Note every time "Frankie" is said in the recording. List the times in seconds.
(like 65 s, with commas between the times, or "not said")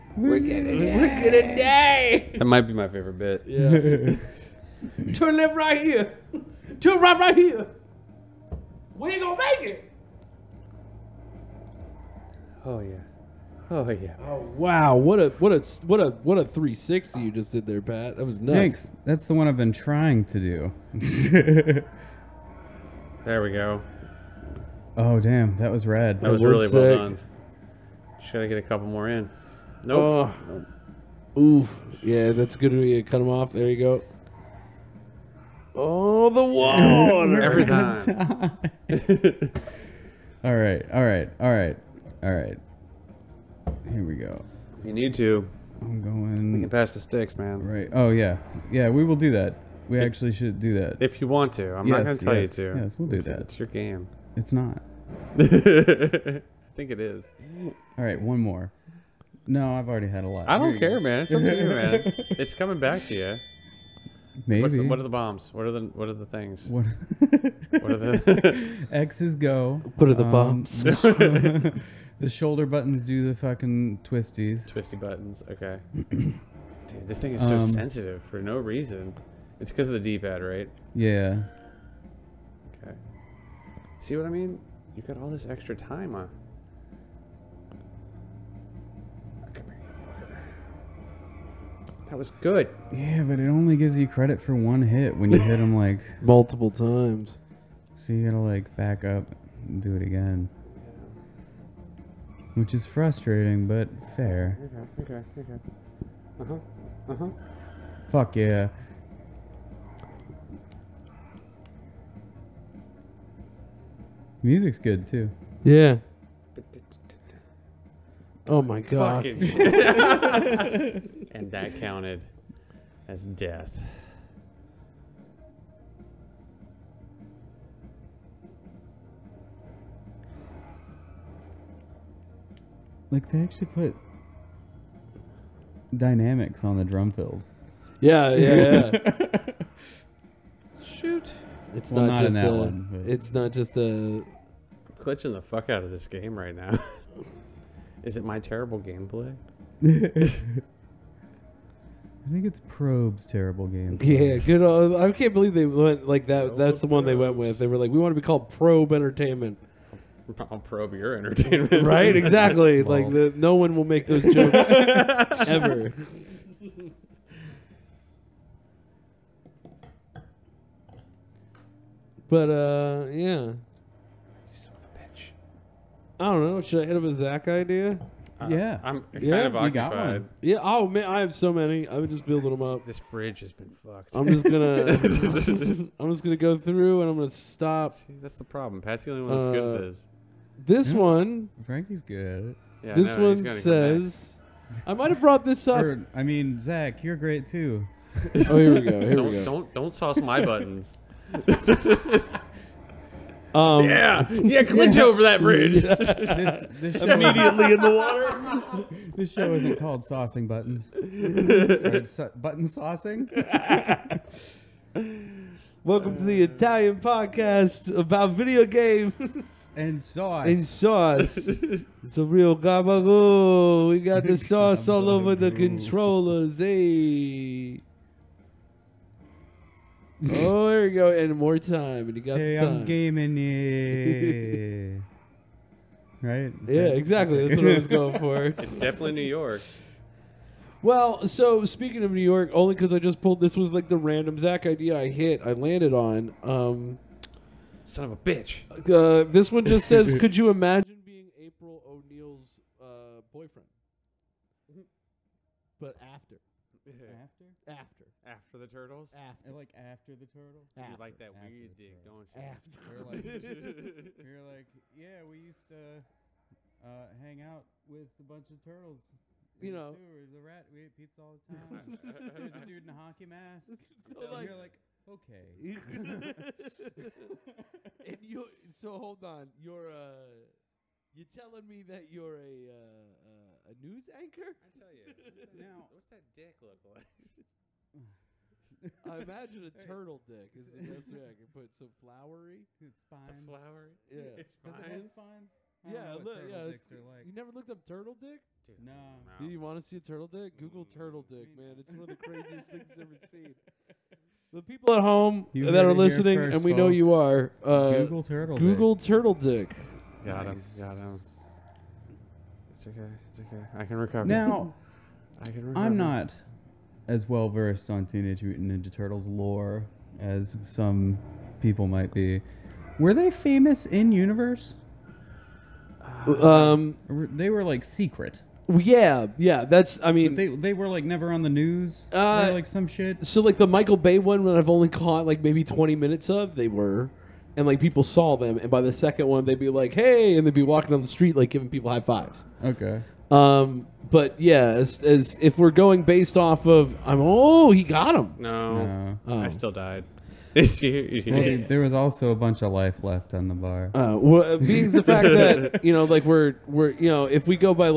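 191 s.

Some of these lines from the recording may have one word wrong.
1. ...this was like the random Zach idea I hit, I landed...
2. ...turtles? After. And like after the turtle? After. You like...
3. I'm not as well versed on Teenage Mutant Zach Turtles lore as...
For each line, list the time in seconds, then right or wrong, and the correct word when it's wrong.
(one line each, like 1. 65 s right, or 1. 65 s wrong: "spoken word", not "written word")
1. 243 s right
2. 258 s right
3. 315 s wrong: "Ninja", not "Zach".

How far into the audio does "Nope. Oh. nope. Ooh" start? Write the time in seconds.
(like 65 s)
29 s.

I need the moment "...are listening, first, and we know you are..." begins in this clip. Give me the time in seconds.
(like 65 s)
305 s.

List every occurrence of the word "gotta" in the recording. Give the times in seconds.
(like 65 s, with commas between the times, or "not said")
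98 s.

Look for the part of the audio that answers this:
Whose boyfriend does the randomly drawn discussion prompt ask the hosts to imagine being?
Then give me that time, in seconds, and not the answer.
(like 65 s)
251 s.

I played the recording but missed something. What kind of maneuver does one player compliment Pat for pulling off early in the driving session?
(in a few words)
A 360.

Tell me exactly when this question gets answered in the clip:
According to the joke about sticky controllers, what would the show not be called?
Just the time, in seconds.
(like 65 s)
210 s.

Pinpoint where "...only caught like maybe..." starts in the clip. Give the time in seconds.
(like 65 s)
334 s.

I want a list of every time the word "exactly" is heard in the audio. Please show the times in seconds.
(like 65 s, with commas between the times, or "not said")
162 s, 236 s.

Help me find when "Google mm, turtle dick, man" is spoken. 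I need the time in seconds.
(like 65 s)
300 s.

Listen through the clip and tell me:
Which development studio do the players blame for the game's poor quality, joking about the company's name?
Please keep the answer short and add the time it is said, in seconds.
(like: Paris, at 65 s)
Probe Entertainment, at 158 s.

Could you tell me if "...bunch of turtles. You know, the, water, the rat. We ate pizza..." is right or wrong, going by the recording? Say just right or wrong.
wrong.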